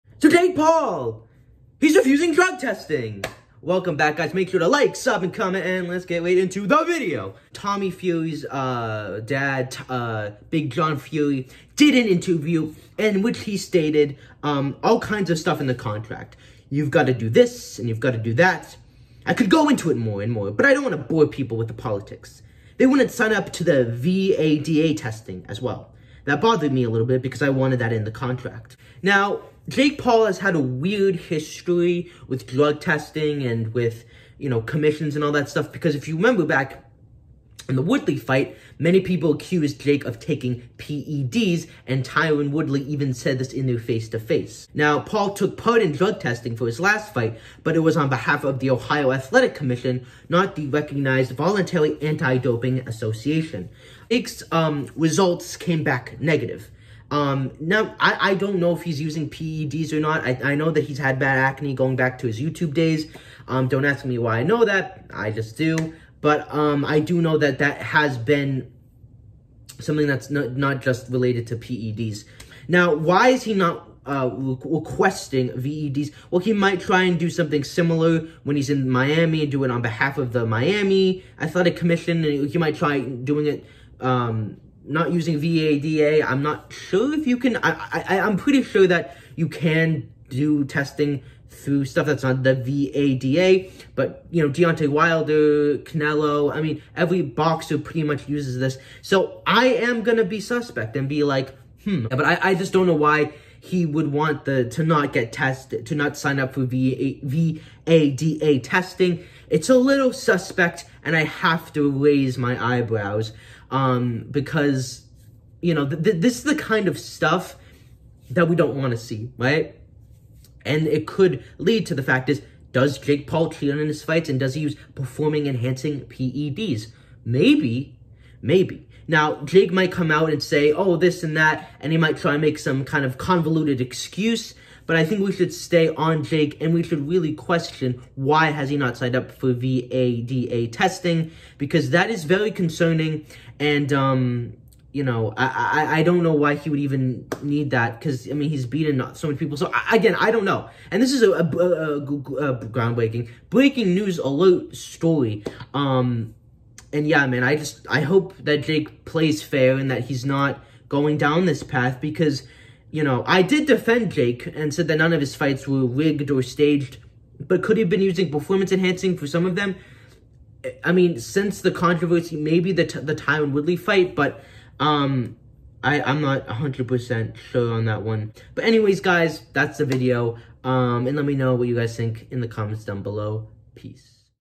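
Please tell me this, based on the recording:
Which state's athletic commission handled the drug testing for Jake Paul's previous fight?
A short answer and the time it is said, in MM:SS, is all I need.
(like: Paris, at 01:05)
Ohio, at 00:48.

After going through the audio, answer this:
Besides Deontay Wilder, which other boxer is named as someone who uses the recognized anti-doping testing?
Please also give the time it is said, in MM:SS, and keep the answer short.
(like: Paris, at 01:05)
Canelo, at 01:35.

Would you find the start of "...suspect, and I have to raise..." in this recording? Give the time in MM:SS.
01:50.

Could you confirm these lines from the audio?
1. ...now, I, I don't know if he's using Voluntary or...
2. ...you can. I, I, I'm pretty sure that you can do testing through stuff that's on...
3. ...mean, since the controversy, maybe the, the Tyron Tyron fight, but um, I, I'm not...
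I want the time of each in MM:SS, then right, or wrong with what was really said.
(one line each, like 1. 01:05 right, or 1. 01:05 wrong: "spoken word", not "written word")
1. 00:57 wrong: "PEDs", not "Voluntary"
2. 01:27 right
3. 02:50 wrong: "Woodley", not "Tyron".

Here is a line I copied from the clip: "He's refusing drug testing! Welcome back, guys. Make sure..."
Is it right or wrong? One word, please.
right.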